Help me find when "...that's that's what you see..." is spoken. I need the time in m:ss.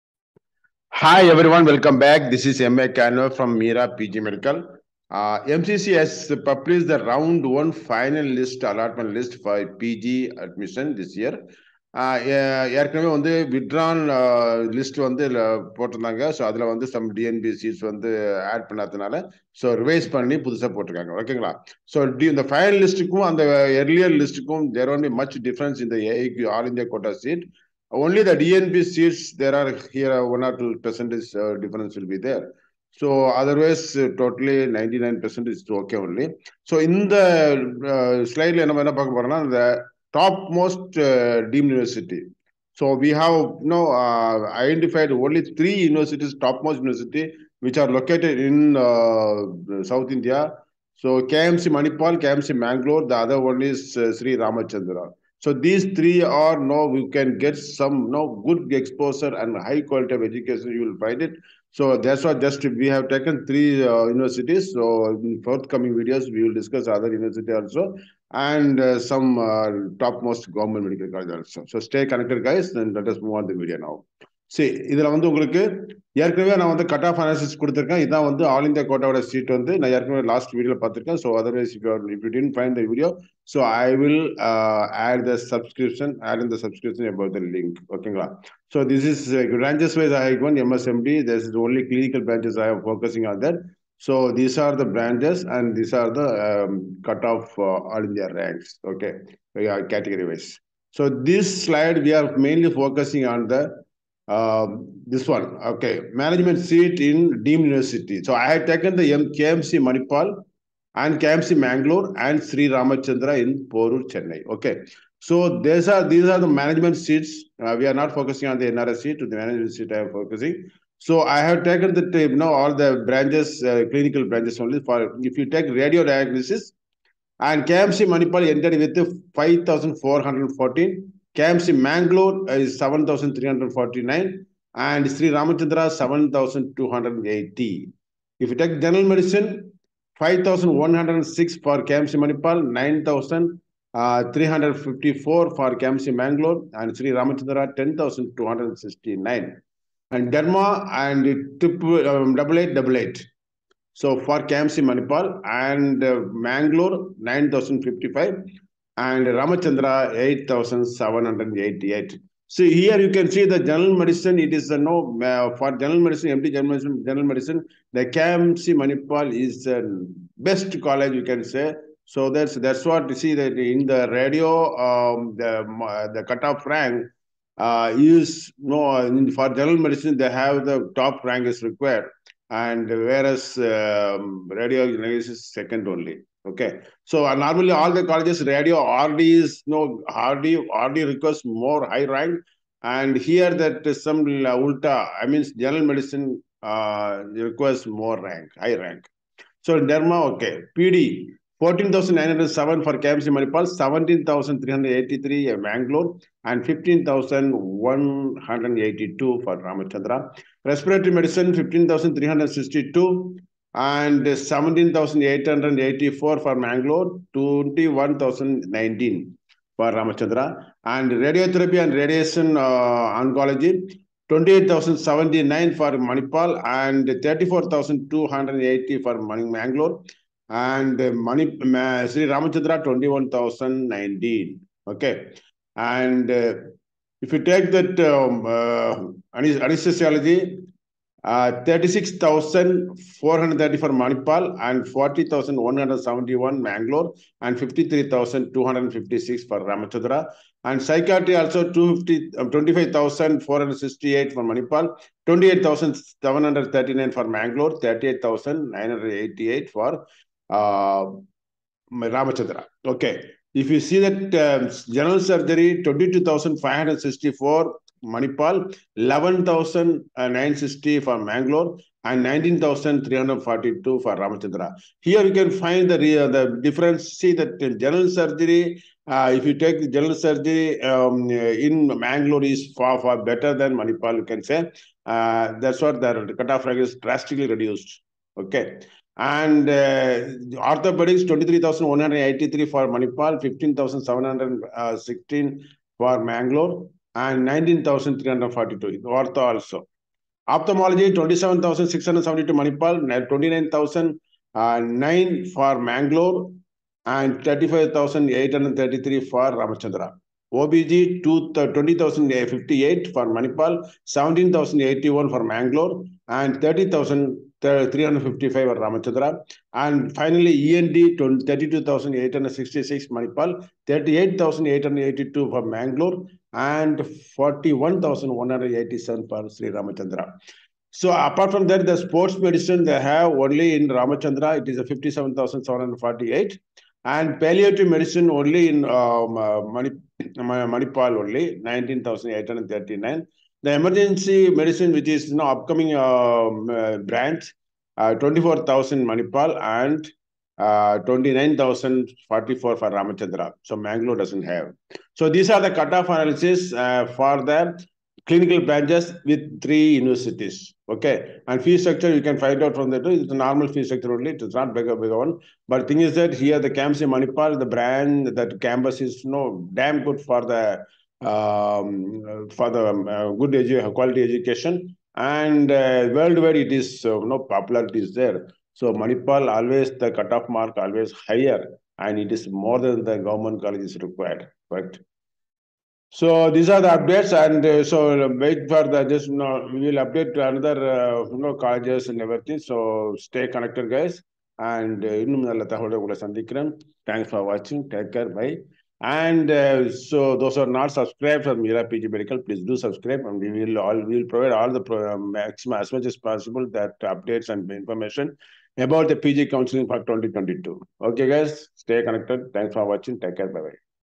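2:52.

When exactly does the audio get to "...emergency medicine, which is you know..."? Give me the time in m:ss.
5:43.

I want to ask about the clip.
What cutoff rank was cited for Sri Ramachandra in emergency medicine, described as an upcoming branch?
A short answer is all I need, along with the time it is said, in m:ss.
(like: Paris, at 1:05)
29,044, at 5:50.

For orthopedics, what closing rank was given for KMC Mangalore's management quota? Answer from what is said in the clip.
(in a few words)
15,716.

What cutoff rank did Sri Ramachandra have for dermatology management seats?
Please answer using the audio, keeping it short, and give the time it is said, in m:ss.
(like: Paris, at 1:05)
8788, at 2:40.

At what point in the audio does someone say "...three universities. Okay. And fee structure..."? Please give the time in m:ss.
5:59.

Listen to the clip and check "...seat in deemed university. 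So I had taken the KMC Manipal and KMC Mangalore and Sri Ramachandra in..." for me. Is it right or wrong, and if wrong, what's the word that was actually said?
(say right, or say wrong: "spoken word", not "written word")
right.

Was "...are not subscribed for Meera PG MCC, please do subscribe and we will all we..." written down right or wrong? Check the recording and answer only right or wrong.
wrong.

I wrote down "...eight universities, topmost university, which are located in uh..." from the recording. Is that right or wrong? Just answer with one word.
wrong.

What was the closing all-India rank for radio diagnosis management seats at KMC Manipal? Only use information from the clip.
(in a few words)
5,414.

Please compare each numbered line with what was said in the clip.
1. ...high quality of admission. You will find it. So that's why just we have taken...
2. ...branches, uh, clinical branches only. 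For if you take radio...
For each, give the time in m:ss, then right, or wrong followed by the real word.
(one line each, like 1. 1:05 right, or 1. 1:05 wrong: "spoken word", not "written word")
1. 0:59 wrong: "education", not "admission"
2. 2:03 right.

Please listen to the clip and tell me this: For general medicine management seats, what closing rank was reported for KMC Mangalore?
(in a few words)
9,354.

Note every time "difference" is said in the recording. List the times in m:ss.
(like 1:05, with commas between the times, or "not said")
0:31, 4:36.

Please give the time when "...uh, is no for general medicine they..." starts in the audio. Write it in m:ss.
2:57.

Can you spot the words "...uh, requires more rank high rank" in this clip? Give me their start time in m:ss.
3:16.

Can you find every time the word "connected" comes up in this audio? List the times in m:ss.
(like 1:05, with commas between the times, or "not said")
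1:12, 6:33, 6:52.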